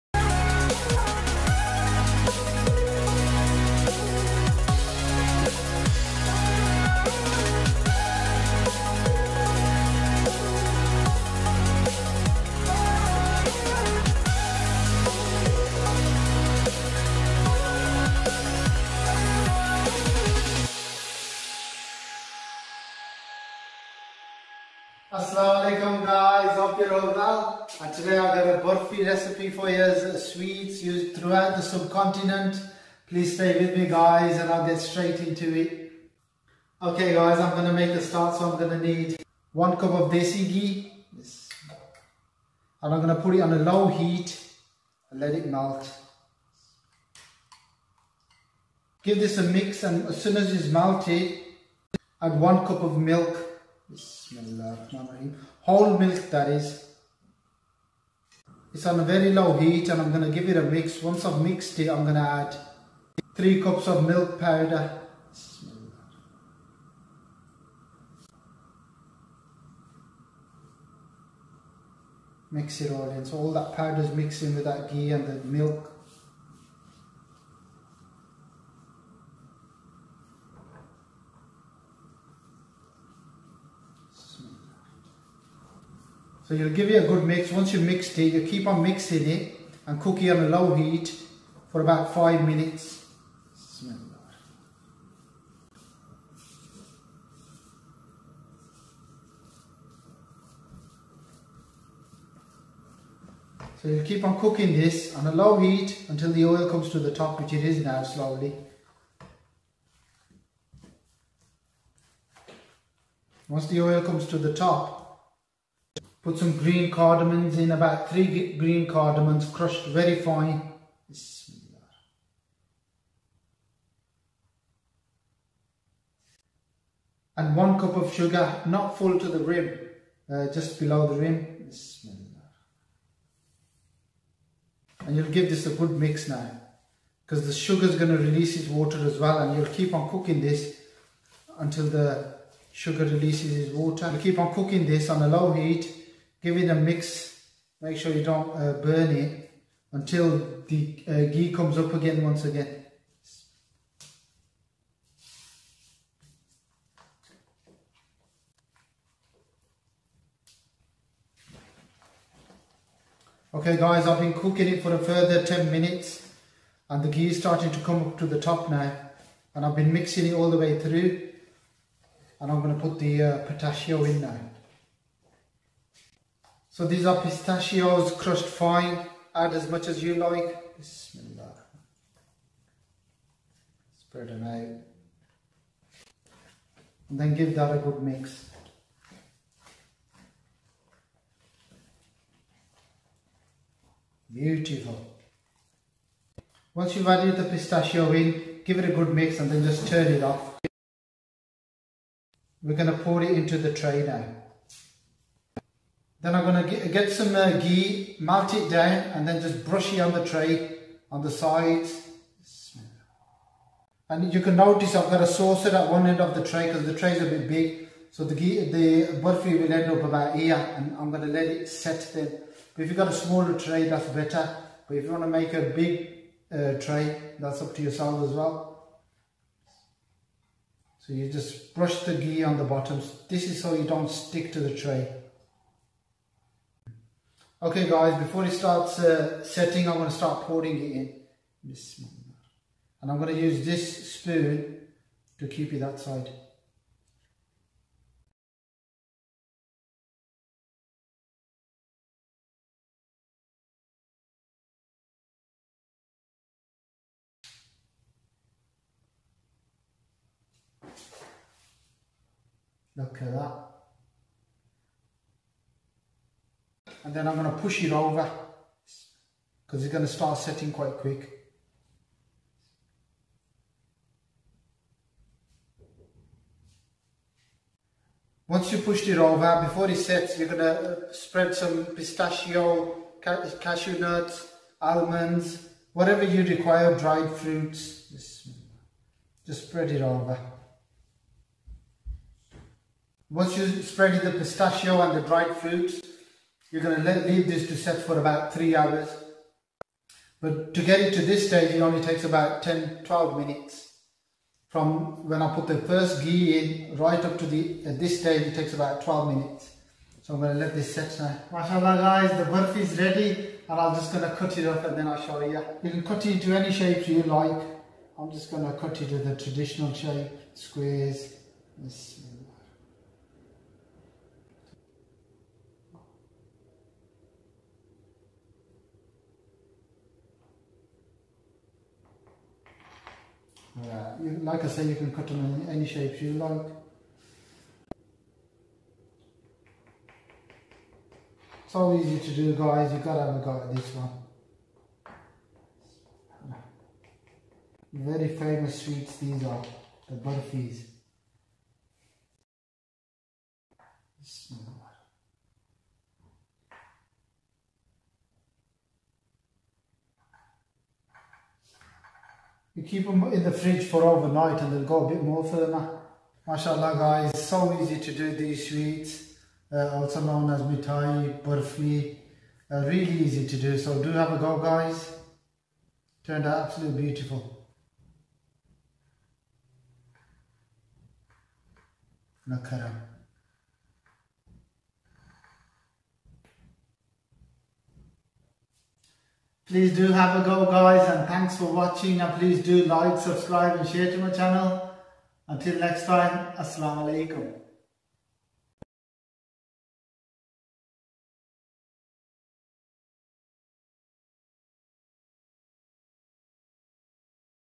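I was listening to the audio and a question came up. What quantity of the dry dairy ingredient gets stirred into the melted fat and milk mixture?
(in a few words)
3 cups.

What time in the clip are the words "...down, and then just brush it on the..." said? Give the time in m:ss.
3:28.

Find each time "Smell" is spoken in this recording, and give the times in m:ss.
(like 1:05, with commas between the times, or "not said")
1:33, 5:54.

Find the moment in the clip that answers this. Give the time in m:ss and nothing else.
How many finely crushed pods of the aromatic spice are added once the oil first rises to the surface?
1:57.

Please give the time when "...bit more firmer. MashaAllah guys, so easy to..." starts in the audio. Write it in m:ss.
6:05.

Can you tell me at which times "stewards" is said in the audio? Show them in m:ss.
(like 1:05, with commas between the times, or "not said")
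not said.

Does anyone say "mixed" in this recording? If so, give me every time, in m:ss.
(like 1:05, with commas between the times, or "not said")
1:01, 1:27.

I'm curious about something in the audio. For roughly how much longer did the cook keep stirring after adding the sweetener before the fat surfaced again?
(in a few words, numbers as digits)
10 minutes.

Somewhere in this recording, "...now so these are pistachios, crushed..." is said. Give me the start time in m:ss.
2:54.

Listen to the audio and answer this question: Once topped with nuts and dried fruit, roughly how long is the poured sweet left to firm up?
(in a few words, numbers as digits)
3 hours.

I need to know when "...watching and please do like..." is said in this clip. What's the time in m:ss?
6:31.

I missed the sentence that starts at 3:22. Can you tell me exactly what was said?
We're going to pour it into the tray now.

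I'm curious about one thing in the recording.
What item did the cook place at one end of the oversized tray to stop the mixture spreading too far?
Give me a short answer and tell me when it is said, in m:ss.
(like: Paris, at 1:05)
A saucer, at 3:35.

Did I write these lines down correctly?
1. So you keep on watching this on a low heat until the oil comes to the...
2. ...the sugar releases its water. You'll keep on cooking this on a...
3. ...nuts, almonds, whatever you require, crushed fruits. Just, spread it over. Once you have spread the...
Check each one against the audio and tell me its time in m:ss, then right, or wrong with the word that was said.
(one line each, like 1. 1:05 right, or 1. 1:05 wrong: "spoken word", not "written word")
1. 1:43 wrong: "cooking", not "watching"
2. 2:21 right
3. 4:43 wrong: "dried", not "crushed".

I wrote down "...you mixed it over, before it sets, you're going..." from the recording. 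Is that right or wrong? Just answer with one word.
wrong.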